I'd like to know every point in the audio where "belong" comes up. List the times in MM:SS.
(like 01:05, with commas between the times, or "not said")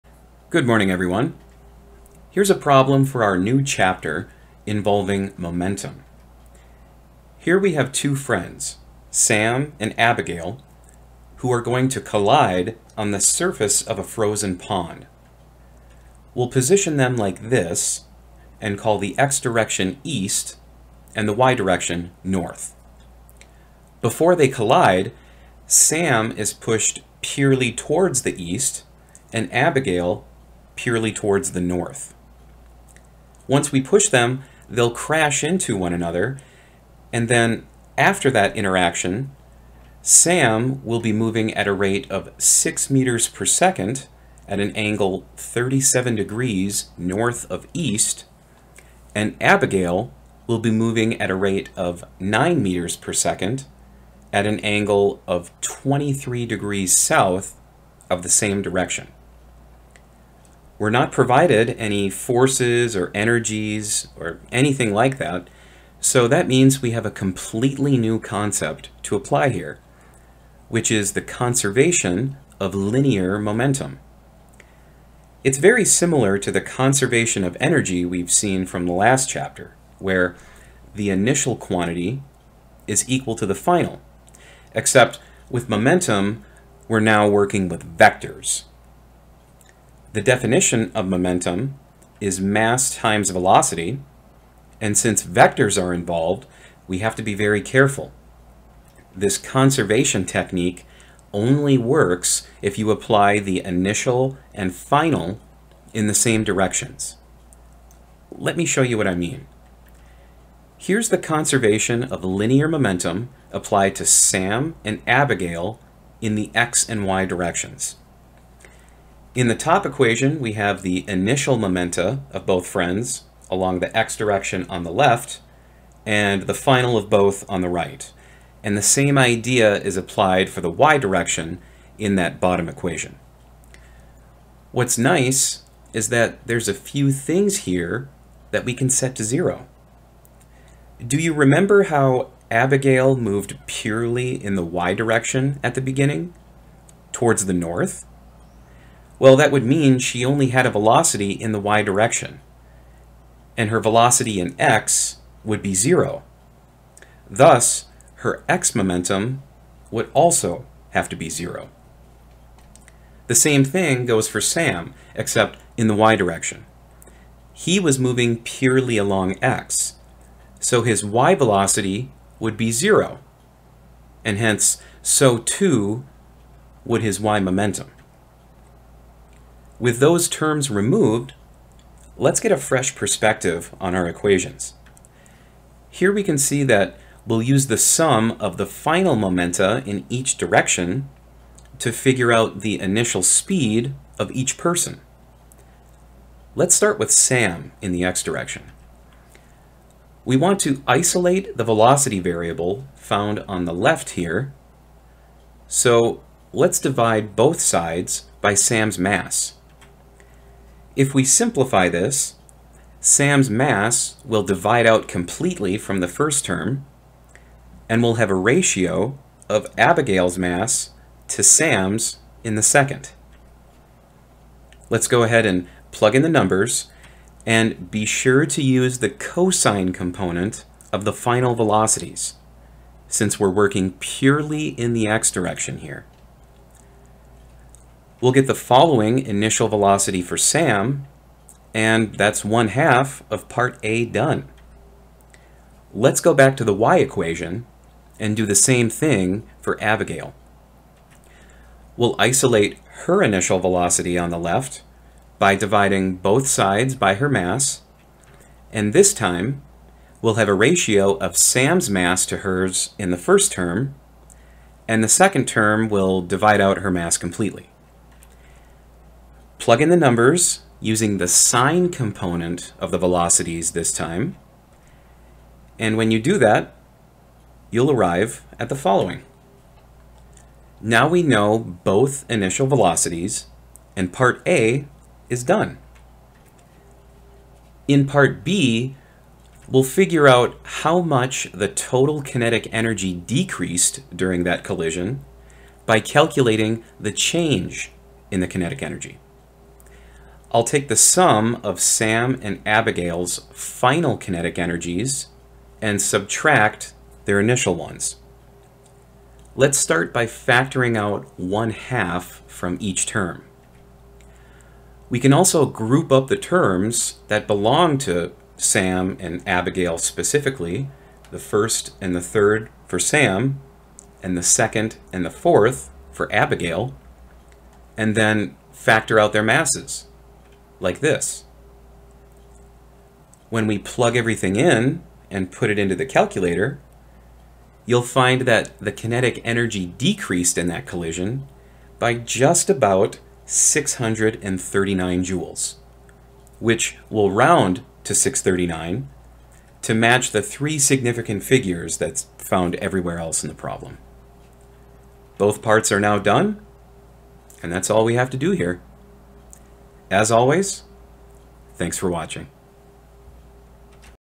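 05:17.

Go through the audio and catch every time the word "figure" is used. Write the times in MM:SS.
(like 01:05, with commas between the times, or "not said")
03:11, 04:49, 05:51.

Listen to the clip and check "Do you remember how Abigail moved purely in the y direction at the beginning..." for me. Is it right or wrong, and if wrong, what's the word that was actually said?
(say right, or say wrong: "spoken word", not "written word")
right.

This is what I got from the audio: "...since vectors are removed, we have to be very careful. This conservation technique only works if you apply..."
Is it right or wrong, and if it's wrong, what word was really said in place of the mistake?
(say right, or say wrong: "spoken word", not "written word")
wrong: "involved", not "removed".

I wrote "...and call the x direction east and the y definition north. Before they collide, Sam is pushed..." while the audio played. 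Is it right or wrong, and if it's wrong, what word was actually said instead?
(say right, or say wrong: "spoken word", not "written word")
wrong: "direction", not "definition".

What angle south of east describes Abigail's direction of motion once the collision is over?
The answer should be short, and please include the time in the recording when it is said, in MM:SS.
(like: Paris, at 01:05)
23 degrees, at 00:55.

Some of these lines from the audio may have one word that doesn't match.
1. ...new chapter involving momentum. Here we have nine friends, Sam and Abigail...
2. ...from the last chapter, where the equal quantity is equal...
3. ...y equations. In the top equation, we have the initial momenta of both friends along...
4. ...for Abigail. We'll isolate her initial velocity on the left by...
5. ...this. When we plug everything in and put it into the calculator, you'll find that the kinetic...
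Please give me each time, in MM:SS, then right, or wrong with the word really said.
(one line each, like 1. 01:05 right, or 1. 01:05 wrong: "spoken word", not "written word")
1. 00:03 wrong: "two", not "nine"
2. 01:18 wrong: "initial", not "equal"
3. 01:57 wrong: "directions", not "equations"
4. 04:09 right
5. 05:30 right.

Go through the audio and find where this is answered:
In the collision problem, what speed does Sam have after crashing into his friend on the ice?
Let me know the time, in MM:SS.
00:42.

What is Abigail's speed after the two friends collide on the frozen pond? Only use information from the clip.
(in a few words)
9 meters per second.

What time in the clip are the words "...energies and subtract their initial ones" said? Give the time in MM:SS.
05:04.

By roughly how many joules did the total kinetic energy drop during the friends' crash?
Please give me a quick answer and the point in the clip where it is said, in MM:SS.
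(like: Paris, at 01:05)
639 joules, at 05:43.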